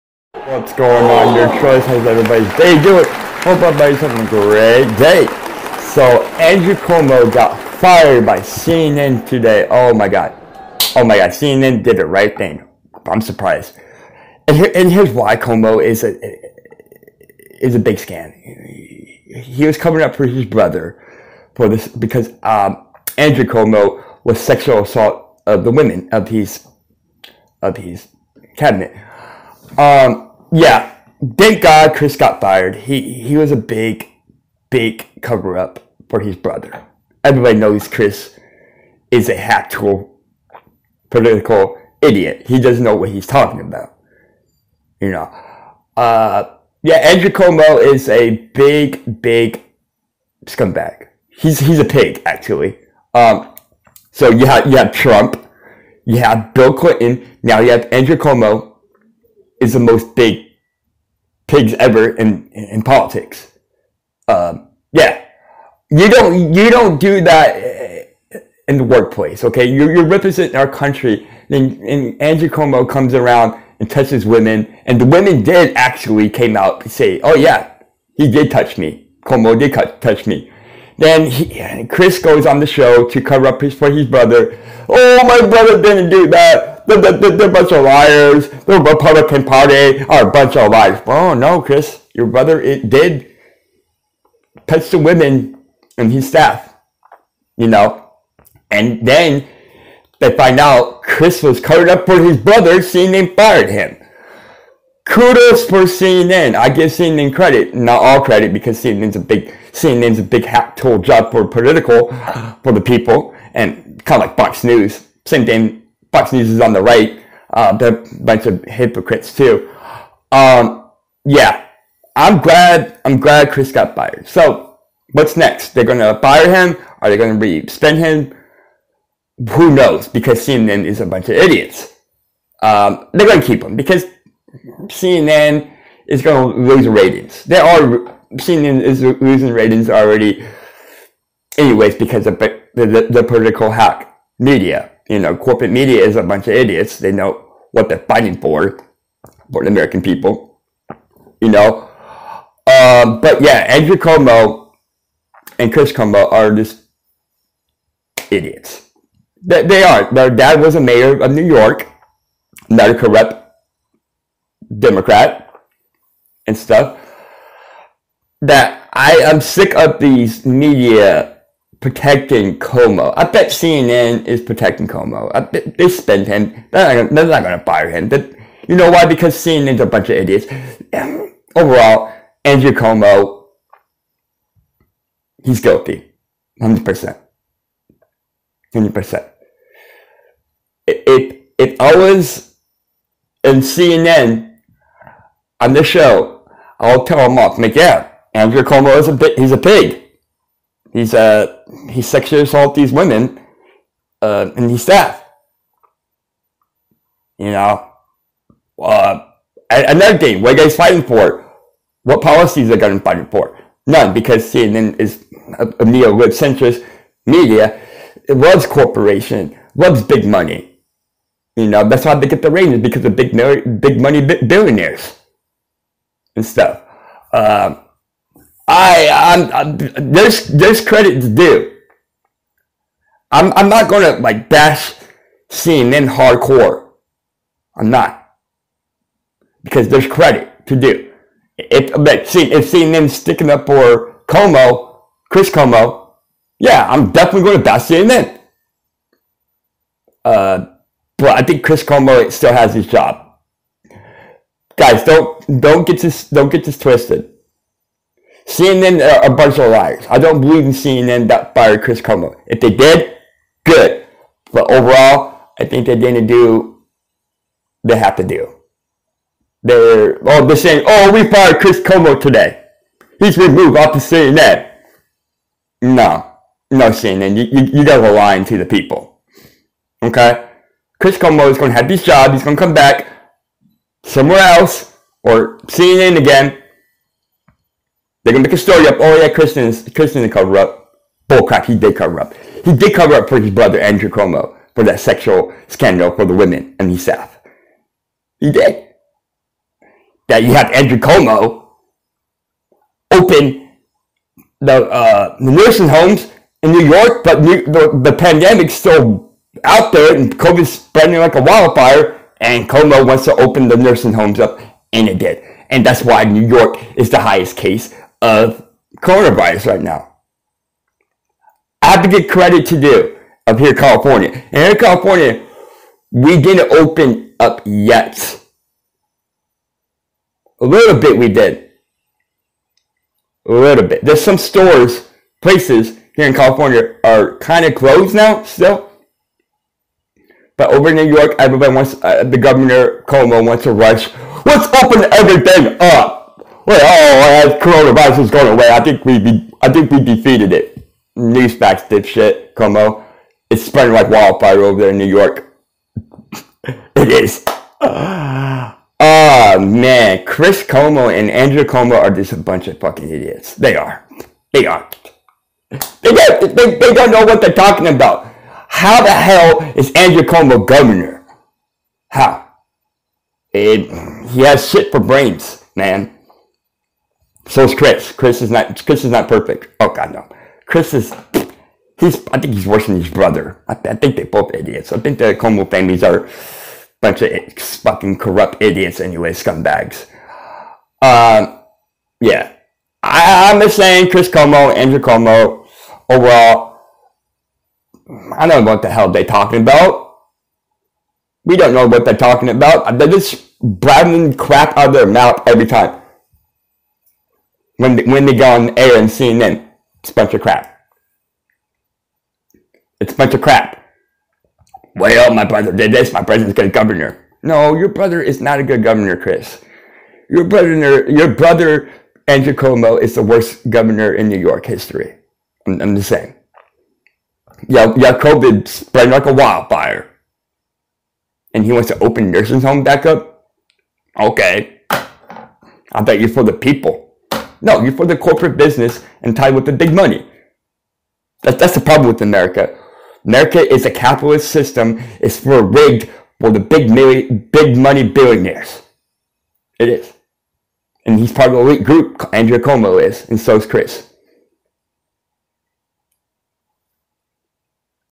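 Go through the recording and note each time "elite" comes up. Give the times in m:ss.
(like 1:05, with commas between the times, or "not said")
7:31.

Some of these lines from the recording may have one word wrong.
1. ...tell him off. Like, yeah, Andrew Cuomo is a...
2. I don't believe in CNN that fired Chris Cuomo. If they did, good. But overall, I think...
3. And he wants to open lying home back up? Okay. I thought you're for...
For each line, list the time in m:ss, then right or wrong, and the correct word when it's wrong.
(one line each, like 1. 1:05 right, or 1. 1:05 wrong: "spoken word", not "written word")
1. 3:17 right
2. 4:20 right
3. 7:11 wrong: "nursing", not "lying".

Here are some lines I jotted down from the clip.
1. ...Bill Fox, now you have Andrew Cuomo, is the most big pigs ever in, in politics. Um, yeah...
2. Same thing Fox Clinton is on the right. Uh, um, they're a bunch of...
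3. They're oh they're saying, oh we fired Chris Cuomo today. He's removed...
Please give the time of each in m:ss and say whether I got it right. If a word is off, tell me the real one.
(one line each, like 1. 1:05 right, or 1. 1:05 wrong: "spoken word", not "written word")
1. 0:56 wrong: "Clinton", not "Fox"
2. 1:55 wrong: "News", not "Clinton"
3. 4:29 right.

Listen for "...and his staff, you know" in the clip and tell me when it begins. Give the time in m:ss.
1:35.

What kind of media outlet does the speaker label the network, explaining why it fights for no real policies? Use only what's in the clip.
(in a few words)
Neo-lib centrist.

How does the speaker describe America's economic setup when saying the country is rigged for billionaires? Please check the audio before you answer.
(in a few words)
Capitalist system.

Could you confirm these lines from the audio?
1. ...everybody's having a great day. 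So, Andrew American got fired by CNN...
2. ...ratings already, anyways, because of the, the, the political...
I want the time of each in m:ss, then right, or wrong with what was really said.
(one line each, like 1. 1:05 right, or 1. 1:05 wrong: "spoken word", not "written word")
1. 0:03 wrong: "Cuomo", not "American"
2. 2:19 right.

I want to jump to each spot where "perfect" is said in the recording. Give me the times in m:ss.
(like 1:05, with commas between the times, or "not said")
6:19.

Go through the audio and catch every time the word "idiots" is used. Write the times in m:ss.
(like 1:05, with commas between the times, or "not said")
0:42, 2:11, 2:26, 2:38, 3:00, 6:03, 6:24, 6:28.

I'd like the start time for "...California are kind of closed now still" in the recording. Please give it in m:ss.
5:36.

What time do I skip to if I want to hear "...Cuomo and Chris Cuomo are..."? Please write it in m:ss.
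2:33.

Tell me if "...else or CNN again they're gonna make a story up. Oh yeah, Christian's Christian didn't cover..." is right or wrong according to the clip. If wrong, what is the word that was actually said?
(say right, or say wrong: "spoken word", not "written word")
right.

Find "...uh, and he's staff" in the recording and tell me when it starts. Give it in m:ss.
3:24.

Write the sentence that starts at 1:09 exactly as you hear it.
Okay, you're, you're representing our country.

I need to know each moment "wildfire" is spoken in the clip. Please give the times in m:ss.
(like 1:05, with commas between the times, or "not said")
5:11, 5:54, 7:09.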